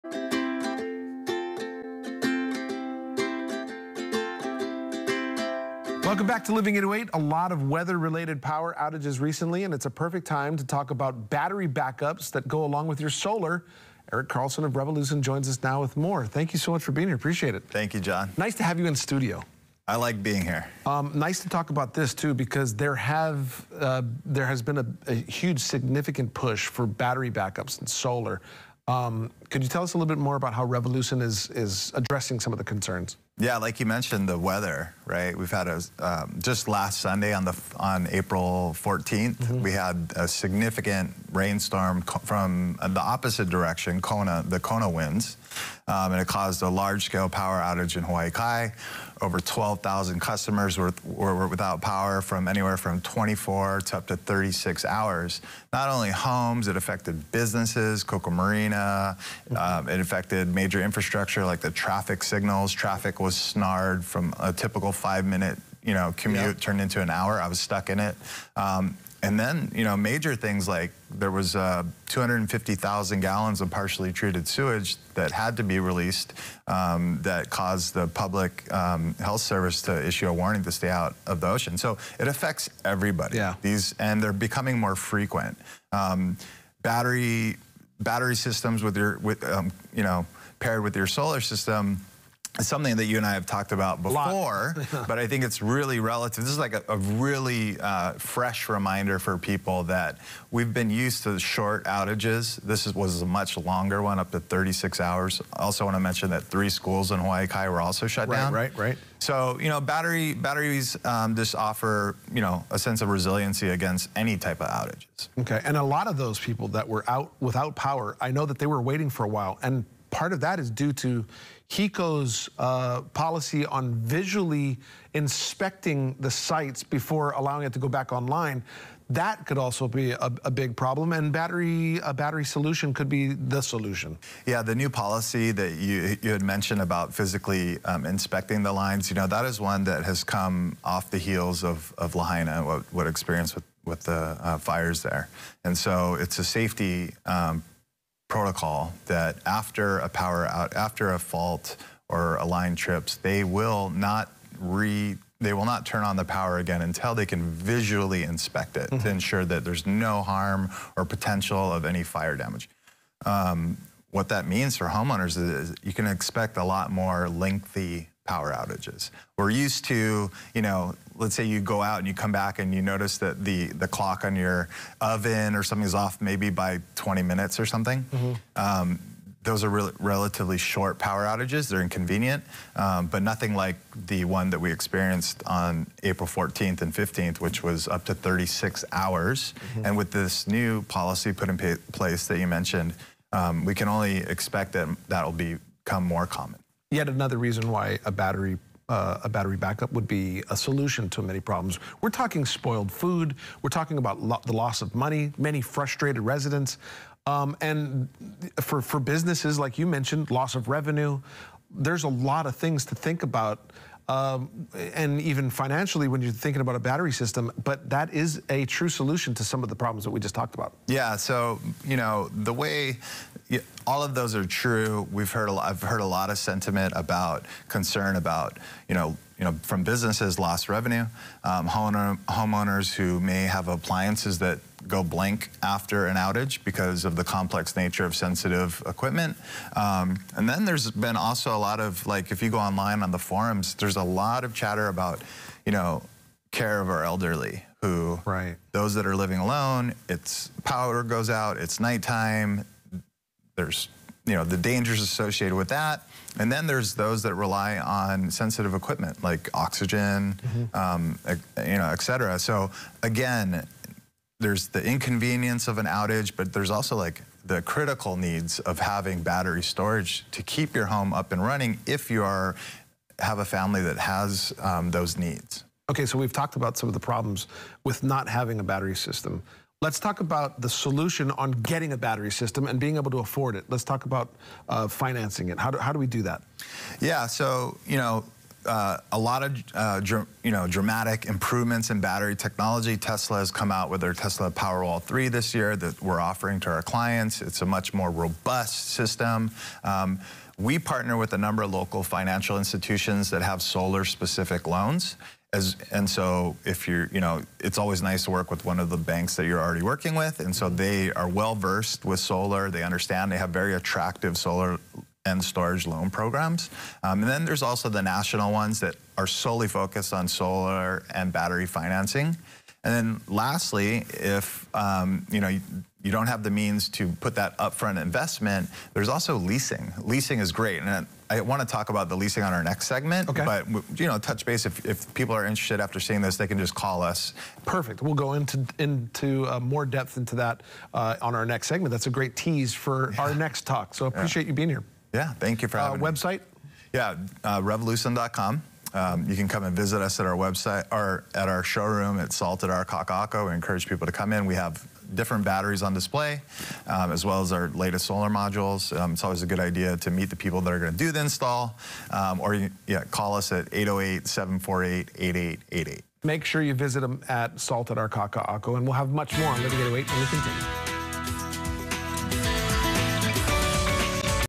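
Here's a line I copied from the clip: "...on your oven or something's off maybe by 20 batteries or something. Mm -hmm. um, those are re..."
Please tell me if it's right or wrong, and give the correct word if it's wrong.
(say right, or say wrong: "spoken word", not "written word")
wrong: "minutes", not "batteries".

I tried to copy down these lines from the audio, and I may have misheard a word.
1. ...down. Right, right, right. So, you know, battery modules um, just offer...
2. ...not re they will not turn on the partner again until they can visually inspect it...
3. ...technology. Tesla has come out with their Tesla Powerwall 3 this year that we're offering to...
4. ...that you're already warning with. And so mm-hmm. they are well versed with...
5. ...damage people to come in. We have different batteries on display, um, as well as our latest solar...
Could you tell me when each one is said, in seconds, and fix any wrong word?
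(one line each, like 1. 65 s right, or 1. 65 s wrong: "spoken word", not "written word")
1. 108 s wrong: "batteries", not "modules"
2. 153 s wrong: "power", not "partner"
3. 292 s right
4. 309 s wrong: "working", not "warning"
5. 353 s wrong: "encourage", not "damage".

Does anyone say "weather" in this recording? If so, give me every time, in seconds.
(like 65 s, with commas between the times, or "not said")
7 s, 34 s.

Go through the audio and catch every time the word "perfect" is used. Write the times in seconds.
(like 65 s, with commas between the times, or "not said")
9 s, 337 s.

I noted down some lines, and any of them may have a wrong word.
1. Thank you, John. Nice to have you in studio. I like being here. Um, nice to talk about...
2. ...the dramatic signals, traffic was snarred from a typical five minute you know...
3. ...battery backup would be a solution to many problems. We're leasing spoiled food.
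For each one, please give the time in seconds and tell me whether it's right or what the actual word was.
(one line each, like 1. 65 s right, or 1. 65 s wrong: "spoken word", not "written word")
1. 17 s right
2. 61 s wrong: "traffic", not "dramatic"
3. 199 s wrong: "talking", not "leasing".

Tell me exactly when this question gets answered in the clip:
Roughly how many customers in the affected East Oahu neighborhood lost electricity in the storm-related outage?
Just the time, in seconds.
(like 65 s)
49 s.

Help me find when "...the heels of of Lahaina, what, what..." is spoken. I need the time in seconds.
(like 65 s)
141 s.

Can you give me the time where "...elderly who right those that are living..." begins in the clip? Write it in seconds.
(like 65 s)
247 s.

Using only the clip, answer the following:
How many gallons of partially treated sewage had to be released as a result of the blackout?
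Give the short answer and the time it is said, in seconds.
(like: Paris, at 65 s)
250,000 gallons, at 72 s.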